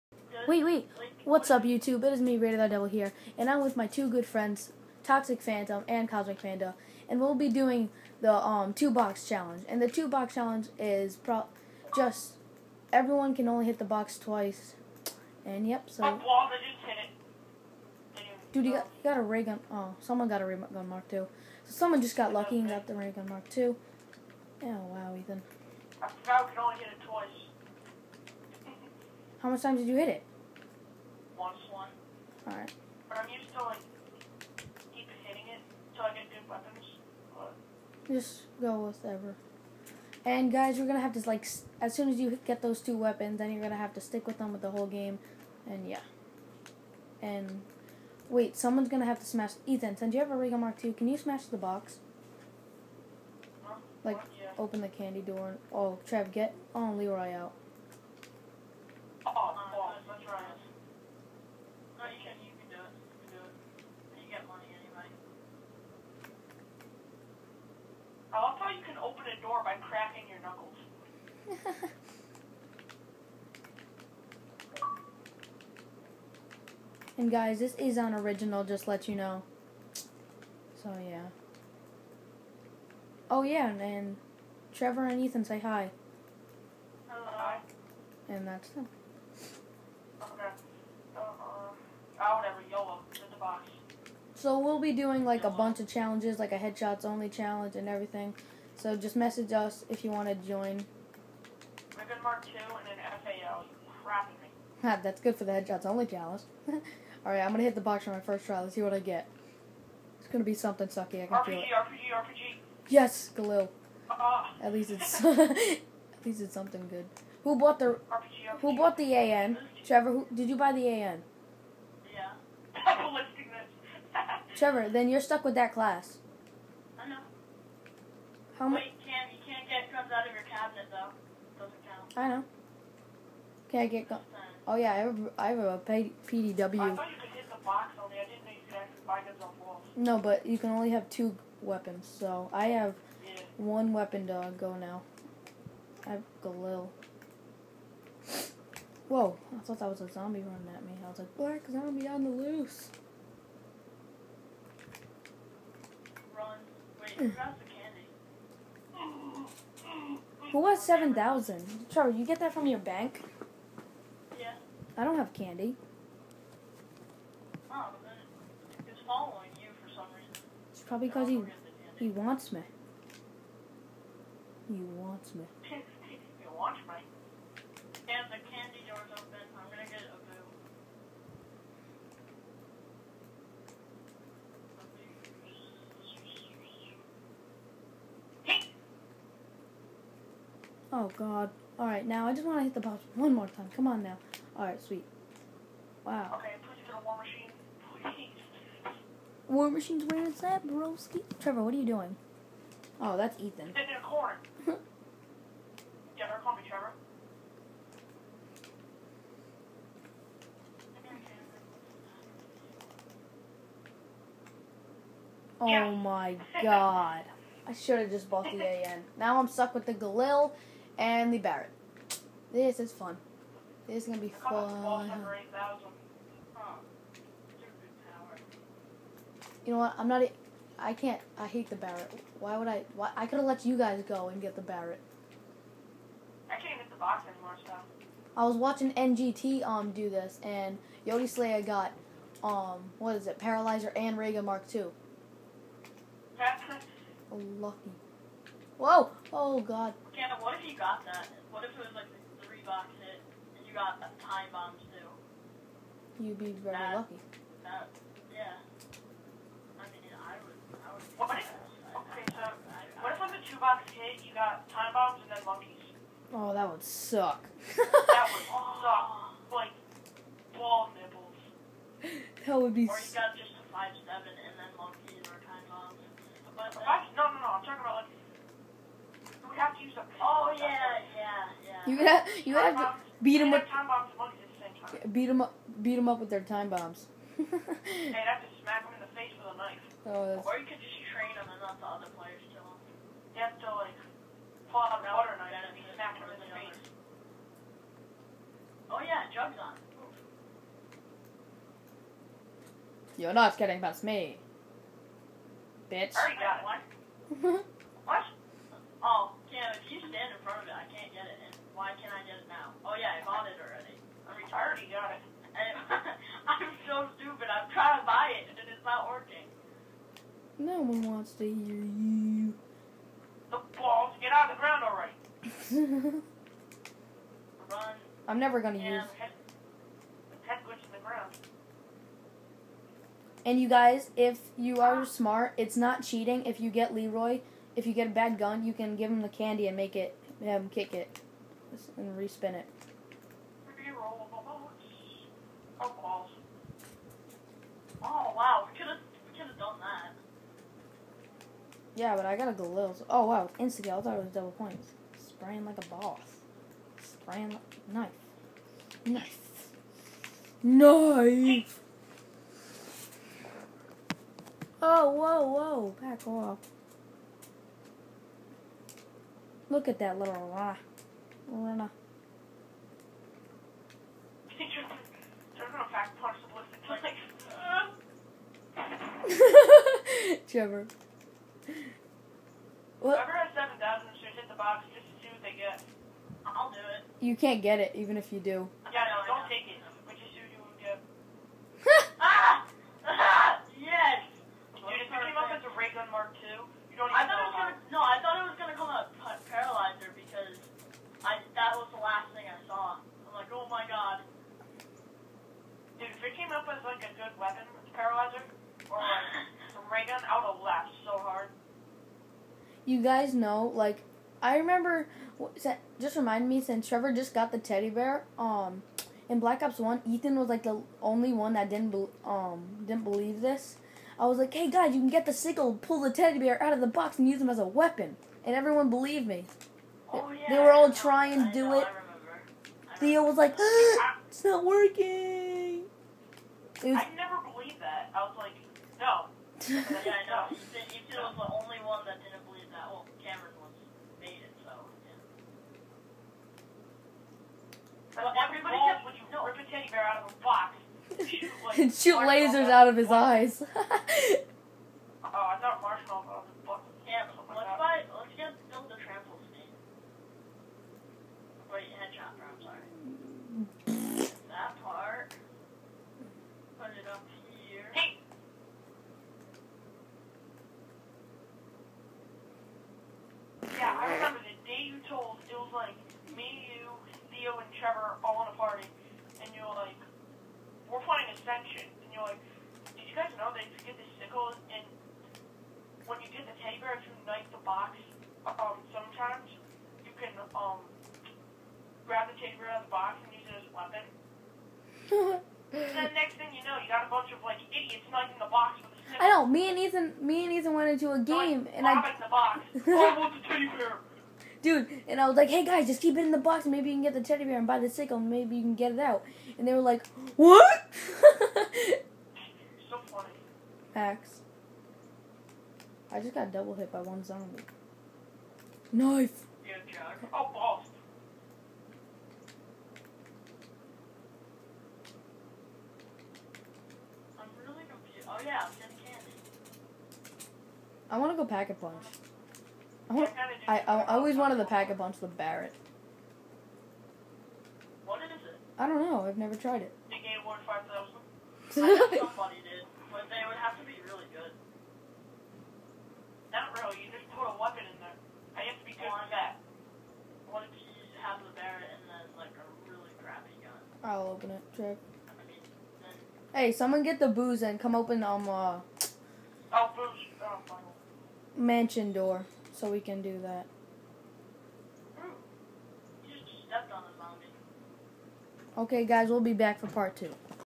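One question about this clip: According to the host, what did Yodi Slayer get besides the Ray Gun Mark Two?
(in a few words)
Paralyzer.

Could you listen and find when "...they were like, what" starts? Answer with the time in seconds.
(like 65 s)
509 s.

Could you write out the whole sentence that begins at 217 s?
I should have just bought the AN.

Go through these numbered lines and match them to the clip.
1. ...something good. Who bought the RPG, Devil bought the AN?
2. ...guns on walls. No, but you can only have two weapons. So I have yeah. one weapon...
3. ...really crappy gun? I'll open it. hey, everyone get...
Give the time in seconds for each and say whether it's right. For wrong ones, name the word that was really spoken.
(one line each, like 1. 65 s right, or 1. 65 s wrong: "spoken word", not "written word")
1. 116 s wrong: "Who", not "Devil"
2. 139 s right
3. 552 s wrong: "someone", not "everyone".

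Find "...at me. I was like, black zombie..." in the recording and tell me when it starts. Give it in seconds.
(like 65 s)
150 s.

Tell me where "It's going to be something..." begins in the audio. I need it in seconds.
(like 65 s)
110 s.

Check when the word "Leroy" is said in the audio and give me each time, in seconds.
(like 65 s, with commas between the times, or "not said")
56 s, 336 s.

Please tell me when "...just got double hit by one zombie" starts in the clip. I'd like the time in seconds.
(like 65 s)
516 s.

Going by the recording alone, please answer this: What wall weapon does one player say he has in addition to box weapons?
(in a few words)
PDW.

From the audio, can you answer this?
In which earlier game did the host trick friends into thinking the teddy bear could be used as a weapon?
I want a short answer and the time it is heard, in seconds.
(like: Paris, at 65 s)
Black Ops One, at 419 s.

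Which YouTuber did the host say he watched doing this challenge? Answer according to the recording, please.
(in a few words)
NGT.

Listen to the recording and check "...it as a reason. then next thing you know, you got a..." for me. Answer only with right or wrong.
wrong.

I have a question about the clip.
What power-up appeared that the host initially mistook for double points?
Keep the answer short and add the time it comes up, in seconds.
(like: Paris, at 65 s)
Insta kill, at 353 s.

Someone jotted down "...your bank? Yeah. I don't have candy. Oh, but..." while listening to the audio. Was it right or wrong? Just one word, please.
right.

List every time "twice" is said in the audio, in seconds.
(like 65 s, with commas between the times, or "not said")
14 s, 27 s.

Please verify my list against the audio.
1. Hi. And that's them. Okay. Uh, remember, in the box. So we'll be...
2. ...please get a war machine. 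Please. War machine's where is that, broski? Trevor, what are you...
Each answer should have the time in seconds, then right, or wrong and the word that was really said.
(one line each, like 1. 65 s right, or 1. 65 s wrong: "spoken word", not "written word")
1. 87 s wrong: "whatever", not "remember"
2. 196 s right.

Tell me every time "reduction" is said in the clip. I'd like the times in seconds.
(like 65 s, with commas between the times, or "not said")
not said.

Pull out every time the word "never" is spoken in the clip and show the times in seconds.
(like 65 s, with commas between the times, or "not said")
328 s, 539 s.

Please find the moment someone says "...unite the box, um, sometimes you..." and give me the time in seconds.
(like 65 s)
487 s.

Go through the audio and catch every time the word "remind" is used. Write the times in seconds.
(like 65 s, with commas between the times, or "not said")
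416 s.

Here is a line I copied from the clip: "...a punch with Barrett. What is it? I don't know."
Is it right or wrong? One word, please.
right.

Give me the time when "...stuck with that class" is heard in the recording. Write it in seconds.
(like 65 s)
125 s.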